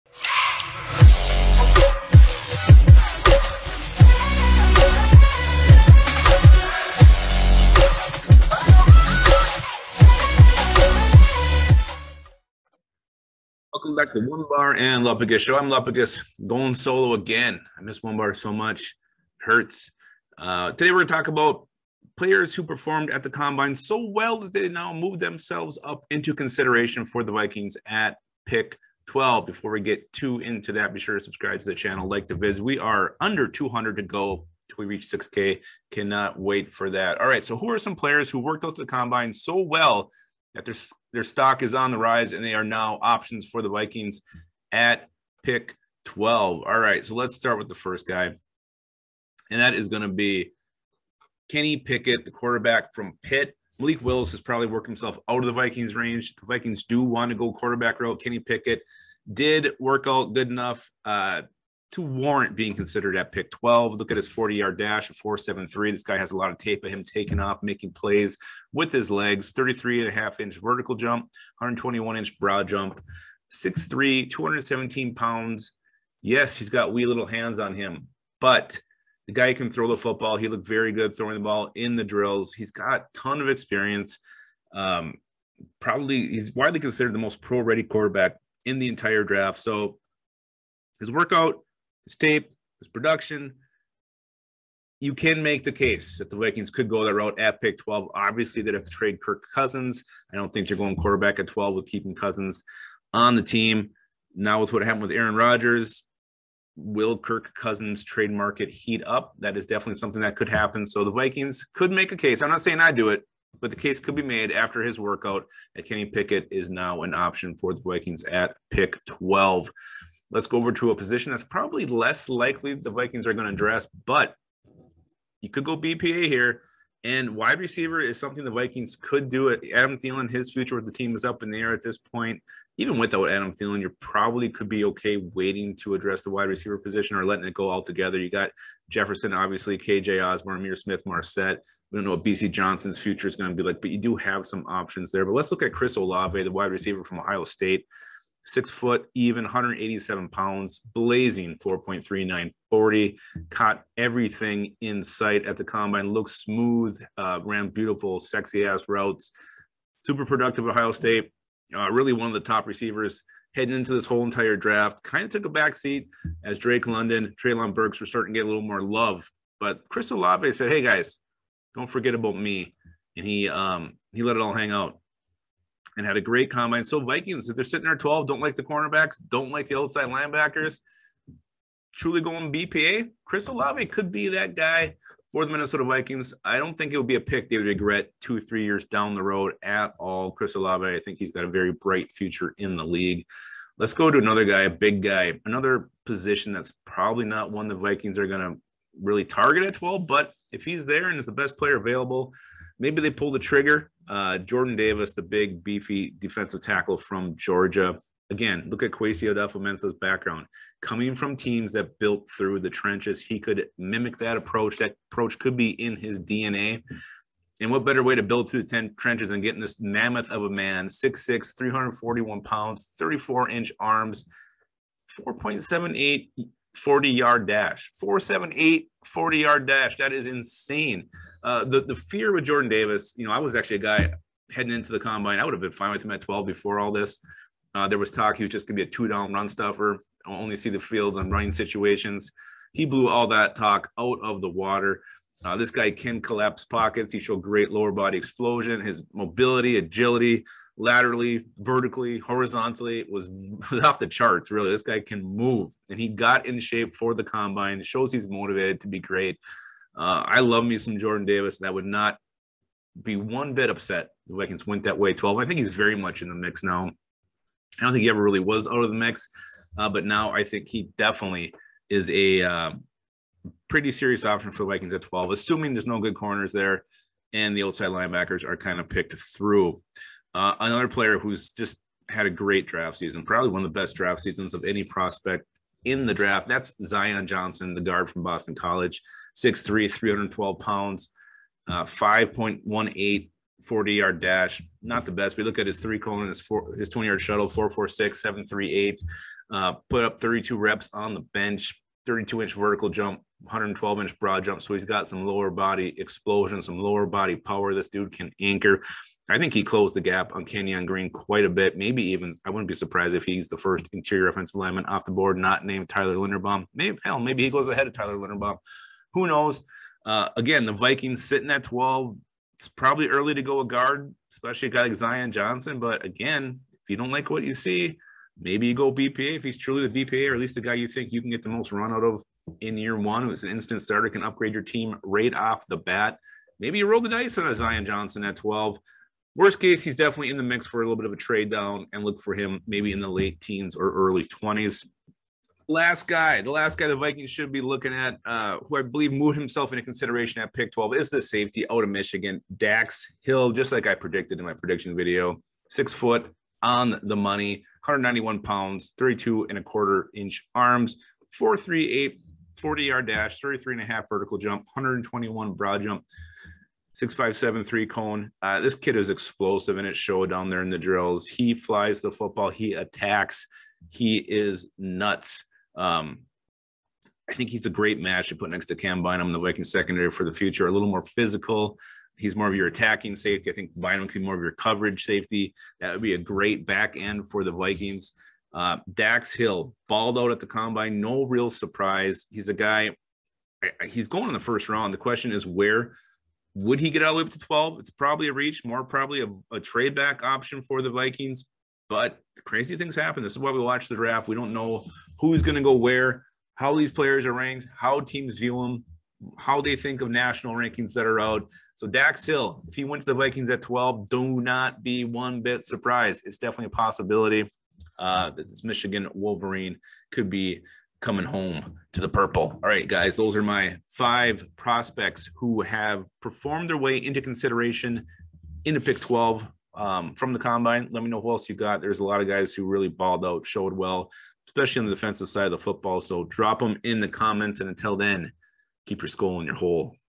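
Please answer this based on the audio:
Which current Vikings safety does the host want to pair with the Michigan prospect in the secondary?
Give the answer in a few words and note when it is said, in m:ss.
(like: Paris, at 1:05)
Cam Bynum, at 6:18.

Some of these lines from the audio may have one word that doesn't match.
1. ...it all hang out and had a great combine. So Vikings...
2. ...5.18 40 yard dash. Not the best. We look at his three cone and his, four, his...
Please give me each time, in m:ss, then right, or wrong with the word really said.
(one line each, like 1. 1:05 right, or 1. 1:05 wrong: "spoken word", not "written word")
1. 2:54 right
2. 4:51 right.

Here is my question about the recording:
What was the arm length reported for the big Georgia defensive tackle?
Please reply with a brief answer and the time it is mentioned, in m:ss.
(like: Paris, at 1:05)
34 inches, at 3:42.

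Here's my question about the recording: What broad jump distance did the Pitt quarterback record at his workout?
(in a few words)
121 inches.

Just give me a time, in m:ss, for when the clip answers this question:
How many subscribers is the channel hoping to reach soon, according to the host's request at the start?
0:35.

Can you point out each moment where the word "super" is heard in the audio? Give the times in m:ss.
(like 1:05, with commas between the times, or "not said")
2:40.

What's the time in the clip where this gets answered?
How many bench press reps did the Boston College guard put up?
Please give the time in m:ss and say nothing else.
5:00.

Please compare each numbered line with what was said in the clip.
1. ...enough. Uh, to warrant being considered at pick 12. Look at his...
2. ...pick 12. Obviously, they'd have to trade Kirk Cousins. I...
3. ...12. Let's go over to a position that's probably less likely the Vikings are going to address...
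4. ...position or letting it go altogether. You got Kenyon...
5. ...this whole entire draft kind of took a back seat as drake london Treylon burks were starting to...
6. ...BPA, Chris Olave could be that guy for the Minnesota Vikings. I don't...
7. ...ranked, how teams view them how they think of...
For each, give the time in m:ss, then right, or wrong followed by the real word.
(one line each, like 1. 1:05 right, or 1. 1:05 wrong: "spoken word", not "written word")
1. 1:00 right
2. 1:37 right
3. 1:59 right
4. 2:16 wrong: "Jefferson", not "Kenyon"
5. 2:43 right
6. 3:02 right
7. 6:47 right.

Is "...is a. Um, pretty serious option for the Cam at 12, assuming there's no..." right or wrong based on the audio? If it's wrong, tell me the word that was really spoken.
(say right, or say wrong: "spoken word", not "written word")
wrong: "Vikings", not "Cam".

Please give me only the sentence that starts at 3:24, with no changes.
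Uh, Jordan Davis, the big, beefy defensive tackle from Georgia.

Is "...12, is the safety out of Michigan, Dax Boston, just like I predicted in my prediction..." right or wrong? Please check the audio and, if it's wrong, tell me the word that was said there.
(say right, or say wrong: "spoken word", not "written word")
wrong: "Hill", not "Boston".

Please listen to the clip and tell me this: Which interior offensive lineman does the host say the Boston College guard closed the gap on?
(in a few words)
Kenyon Green.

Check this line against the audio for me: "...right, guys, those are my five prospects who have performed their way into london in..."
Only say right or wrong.
wrong.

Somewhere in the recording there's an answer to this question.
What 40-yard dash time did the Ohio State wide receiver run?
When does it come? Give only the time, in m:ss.
2:31.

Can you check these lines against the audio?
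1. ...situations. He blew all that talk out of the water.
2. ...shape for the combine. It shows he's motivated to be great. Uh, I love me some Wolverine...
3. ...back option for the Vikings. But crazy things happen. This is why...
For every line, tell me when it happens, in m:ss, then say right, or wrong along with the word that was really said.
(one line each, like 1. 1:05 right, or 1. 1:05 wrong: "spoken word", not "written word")
1. 4:01 right
2. 4:16 wrong: "Jordan", not "Wolverine"
3. 6:39 right.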